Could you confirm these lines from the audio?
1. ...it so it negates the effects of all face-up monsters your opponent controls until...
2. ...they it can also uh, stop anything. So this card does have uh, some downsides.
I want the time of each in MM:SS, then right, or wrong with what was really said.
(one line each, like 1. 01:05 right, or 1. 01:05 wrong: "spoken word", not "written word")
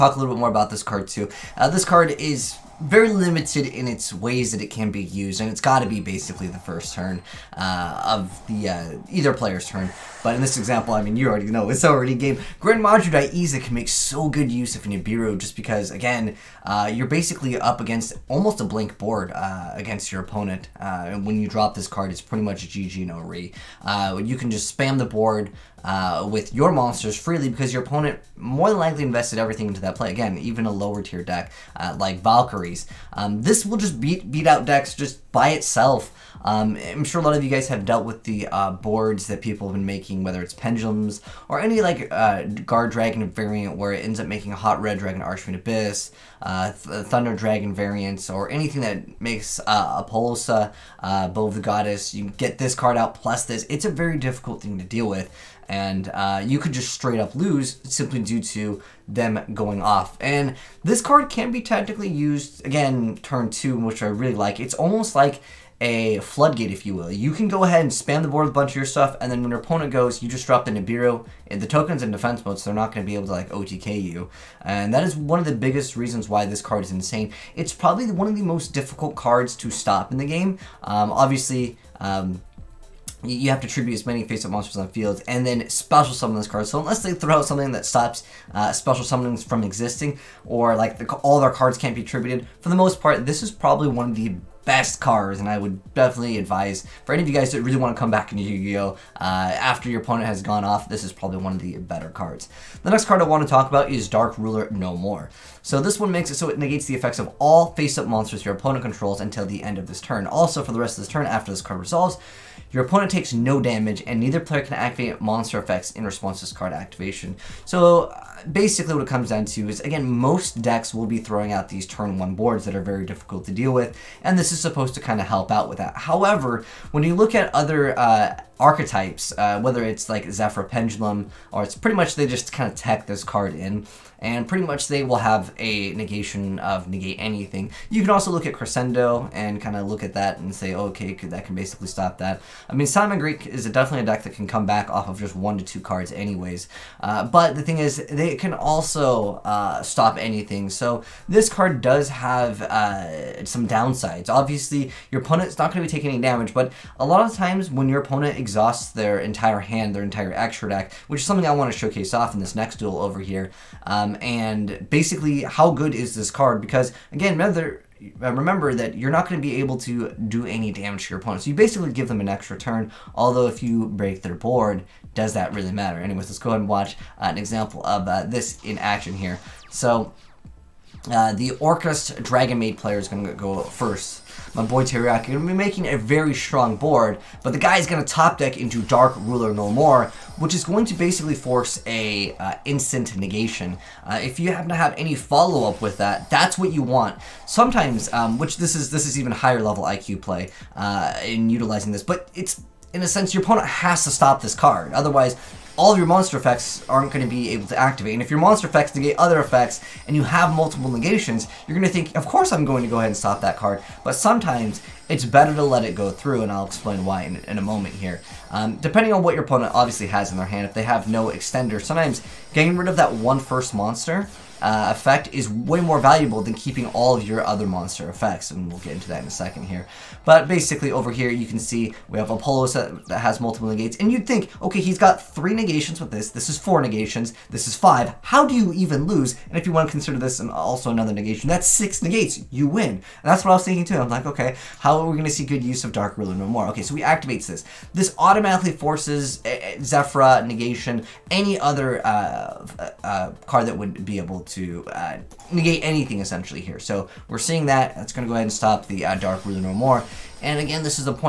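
1. 01:46 right
2. 02:28 right.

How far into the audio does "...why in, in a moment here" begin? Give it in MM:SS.
03:37.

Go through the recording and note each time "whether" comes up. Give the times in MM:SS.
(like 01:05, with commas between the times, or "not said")
00:40, 02:09.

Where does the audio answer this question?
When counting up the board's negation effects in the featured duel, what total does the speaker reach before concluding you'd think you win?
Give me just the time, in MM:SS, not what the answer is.
04:01.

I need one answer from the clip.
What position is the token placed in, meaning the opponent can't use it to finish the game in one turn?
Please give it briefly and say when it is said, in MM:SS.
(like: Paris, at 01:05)
Defense mode, at 01:12.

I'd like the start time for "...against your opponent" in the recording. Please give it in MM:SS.
00:19.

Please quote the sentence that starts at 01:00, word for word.
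And this card can be tactically used, again, turn 2, which I really like.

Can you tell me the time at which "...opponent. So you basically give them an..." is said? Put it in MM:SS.
02:51.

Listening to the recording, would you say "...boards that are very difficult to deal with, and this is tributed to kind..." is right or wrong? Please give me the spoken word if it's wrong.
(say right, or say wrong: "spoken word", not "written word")
wrong: "supposed", not "tributed".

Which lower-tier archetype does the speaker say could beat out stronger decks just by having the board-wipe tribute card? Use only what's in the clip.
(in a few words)
Valkyries.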